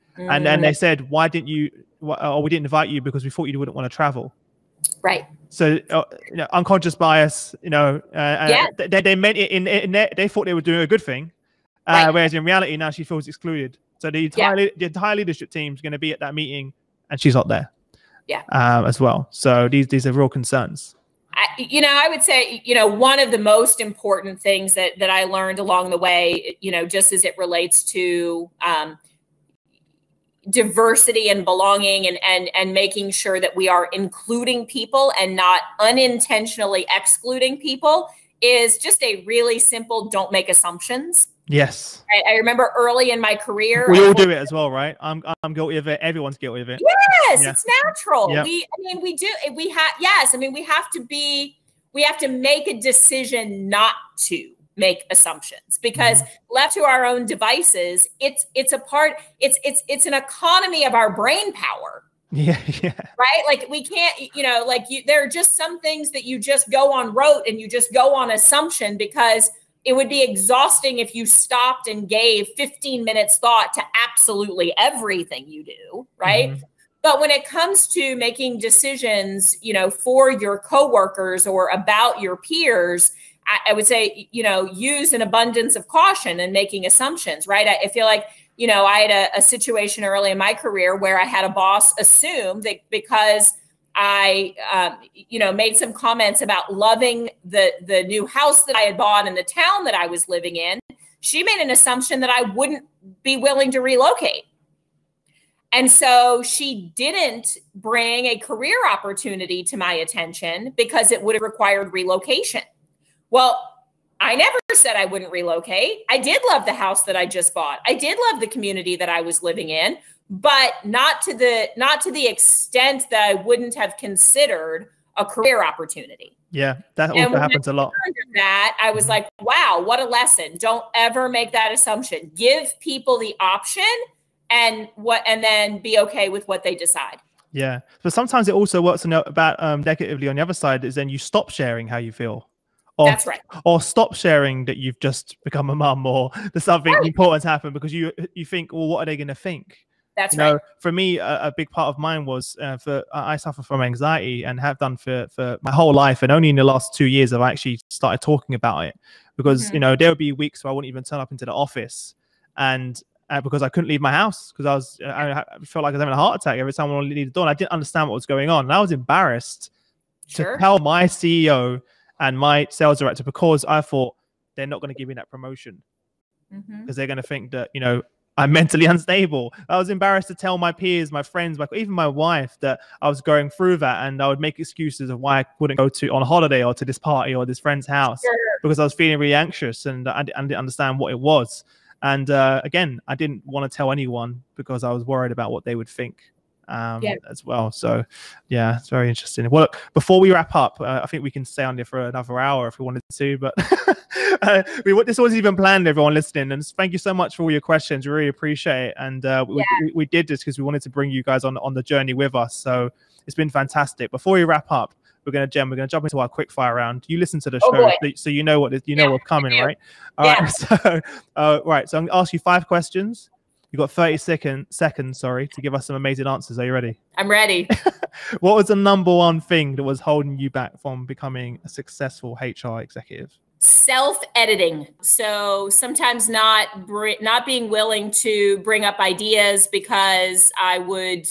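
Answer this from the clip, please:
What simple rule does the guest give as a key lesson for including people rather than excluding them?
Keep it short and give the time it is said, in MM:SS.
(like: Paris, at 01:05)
Don't make assumptions, at 00:40.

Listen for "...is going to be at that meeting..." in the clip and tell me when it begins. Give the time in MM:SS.
00:15.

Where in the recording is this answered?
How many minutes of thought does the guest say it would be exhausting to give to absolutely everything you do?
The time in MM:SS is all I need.
01:12.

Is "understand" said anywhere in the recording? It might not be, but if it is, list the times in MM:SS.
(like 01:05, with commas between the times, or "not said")
02:47, 03:10.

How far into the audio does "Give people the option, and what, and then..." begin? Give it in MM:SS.
02:12.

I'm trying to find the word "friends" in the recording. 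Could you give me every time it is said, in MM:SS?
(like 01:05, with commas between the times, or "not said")
03:01, 03:07.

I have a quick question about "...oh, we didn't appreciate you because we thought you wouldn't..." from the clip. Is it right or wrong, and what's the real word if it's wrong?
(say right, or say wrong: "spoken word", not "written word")
wrong: "invite", not "appreciate".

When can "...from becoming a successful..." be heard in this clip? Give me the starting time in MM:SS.
03:50.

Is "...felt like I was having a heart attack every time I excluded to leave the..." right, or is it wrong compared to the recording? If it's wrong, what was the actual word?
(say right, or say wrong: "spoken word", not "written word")
wrong: "wanted", not "excluded".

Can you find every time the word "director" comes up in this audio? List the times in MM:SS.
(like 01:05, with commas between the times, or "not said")
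02:53.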